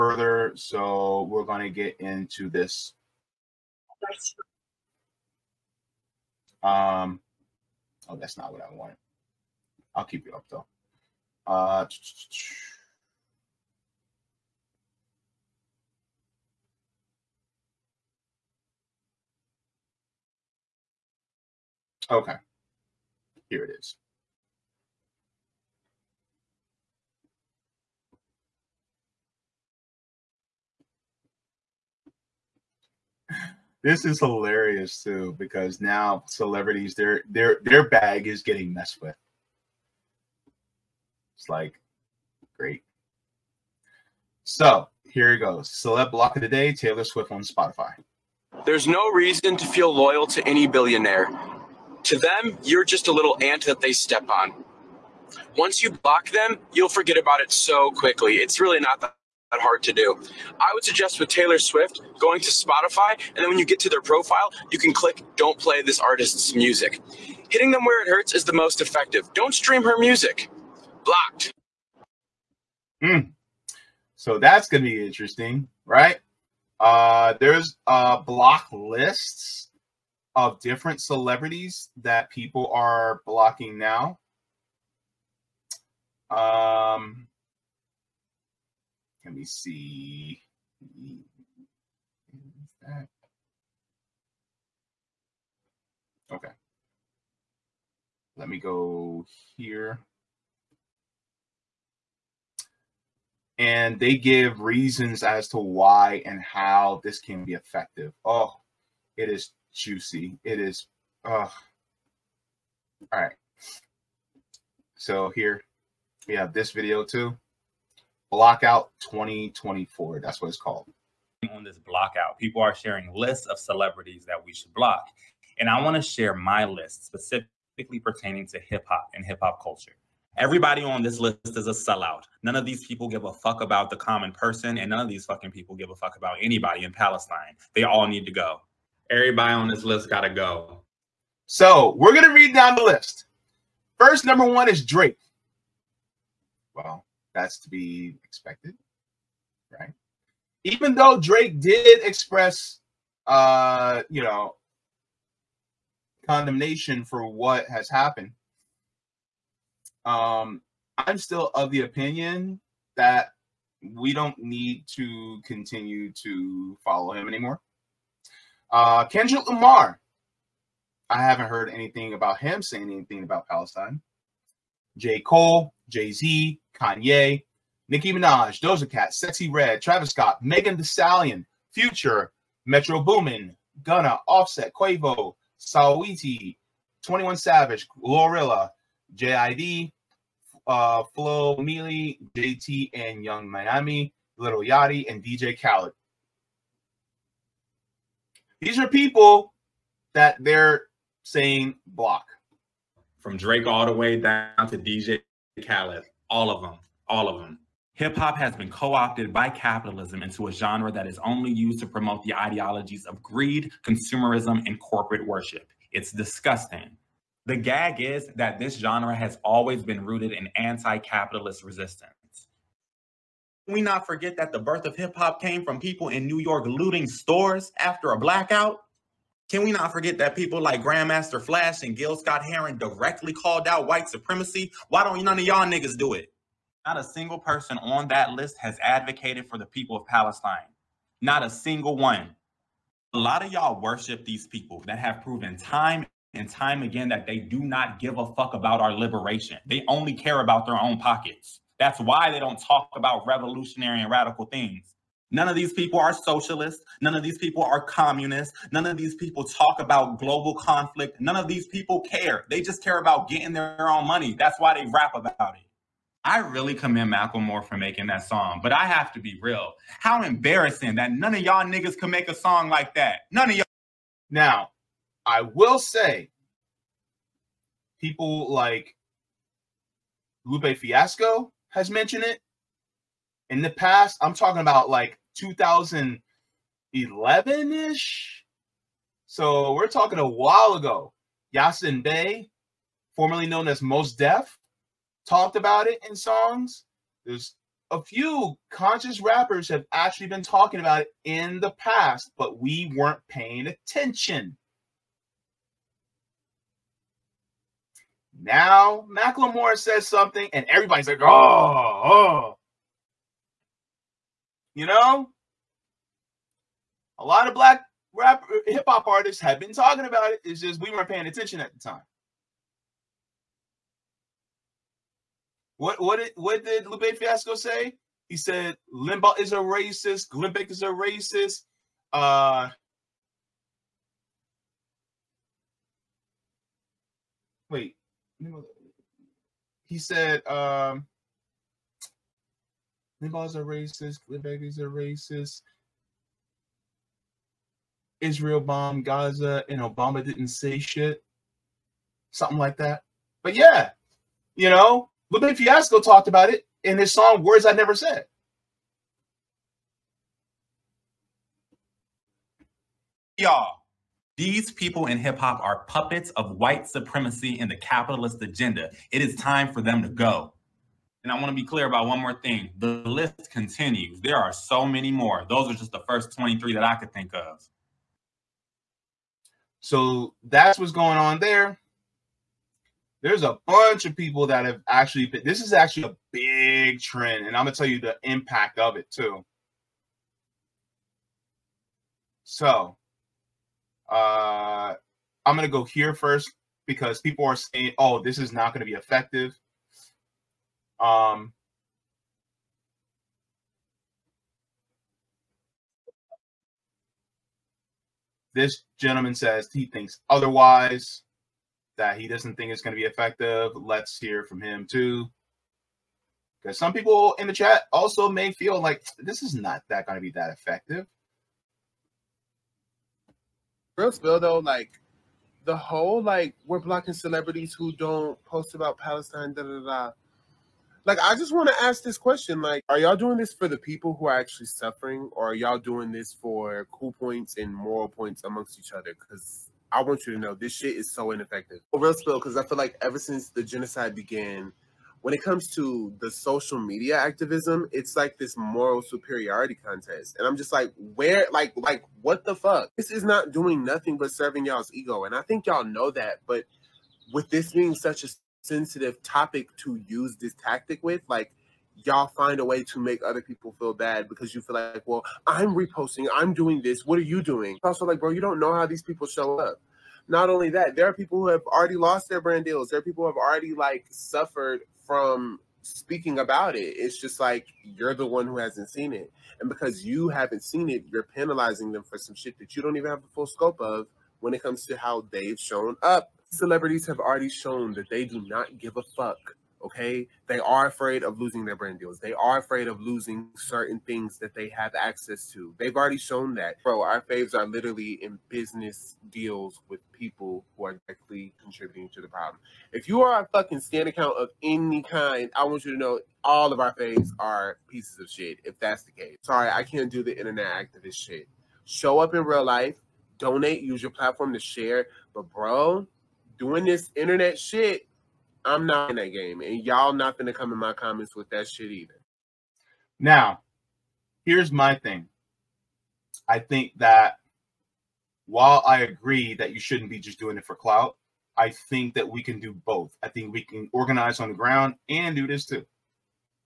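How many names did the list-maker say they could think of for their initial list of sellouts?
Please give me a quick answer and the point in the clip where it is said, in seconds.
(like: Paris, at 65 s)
23, at 376 s.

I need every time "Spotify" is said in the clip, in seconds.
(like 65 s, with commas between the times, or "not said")
47 s, 62 s.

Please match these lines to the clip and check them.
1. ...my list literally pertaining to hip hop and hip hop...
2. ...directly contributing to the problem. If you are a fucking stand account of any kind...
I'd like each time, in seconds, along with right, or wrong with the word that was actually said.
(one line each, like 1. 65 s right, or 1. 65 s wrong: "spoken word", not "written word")
1. 126 s wrong: "specifically", not "literally"
2. 501 s right.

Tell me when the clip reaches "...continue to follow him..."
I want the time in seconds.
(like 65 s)
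165 s.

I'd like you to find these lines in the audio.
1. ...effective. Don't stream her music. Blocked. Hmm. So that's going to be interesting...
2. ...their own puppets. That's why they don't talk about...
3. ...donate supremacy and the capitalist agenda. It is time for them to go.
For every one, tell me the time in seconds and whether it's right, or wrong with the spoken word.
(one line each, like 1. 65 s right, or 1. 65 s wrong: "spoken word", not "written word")
1. 68 s right
2. 250 s wrong: "pockets", not "puppets"
3. 366 s wrong: "white", not "donate".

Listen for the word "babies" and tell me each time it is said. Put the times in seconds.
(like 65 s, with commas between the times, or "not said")
not said.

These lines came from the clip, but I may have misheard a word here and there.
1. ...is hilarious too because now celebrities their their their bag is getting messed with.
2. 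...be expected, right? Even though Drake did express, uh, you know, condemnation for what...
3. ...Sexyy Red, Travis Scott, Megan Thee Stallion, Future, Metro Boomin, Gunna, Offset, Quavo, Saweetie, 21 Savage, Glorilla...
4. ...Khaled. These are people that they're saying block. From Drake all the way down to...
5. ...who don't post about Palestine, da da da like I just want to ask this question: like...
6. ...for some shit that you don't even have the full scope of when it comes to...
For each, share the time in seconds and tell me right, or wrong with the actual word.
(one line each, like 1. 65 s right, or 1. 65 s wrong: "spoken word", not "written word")
1. 34 s right
2. 147 s right
3. 179 s right
4. 195 s right
5. 427 s right
6. 482 s right.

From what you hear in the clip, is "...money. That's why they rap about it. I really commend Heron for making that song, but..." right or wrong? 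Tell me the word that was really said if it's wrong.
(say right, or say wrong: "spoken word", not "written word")
wrong: "Macklemore", not "Heron".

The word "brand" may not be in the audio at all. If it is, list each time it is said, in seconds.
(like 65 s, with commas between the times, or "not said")
472 s, 491 s.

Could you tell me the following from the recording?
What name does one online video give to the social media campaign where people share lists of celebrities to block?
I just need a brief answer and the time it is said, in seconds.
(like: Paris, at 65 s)
Blockout 2024, at 118 s.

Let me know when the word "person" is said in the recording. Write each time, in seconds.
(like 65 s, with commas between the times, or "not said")
134 s, 237 s.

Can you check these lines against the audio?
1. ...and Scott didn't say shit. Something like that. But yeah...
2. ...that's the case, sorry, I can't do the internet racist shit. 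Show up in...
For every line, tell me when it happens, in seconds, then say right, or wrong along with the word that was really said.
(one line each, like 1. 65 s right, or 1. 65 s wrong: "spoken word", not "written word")
1. 349 s wrong: "Obama", not "Scott"
2. 508 s wrong: "activist", not "racist".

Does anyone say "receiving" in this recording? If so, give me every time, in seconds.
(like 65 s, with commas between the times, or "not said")
not said.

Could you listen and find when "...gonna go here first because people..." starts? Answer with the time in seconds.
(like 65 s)
395 s.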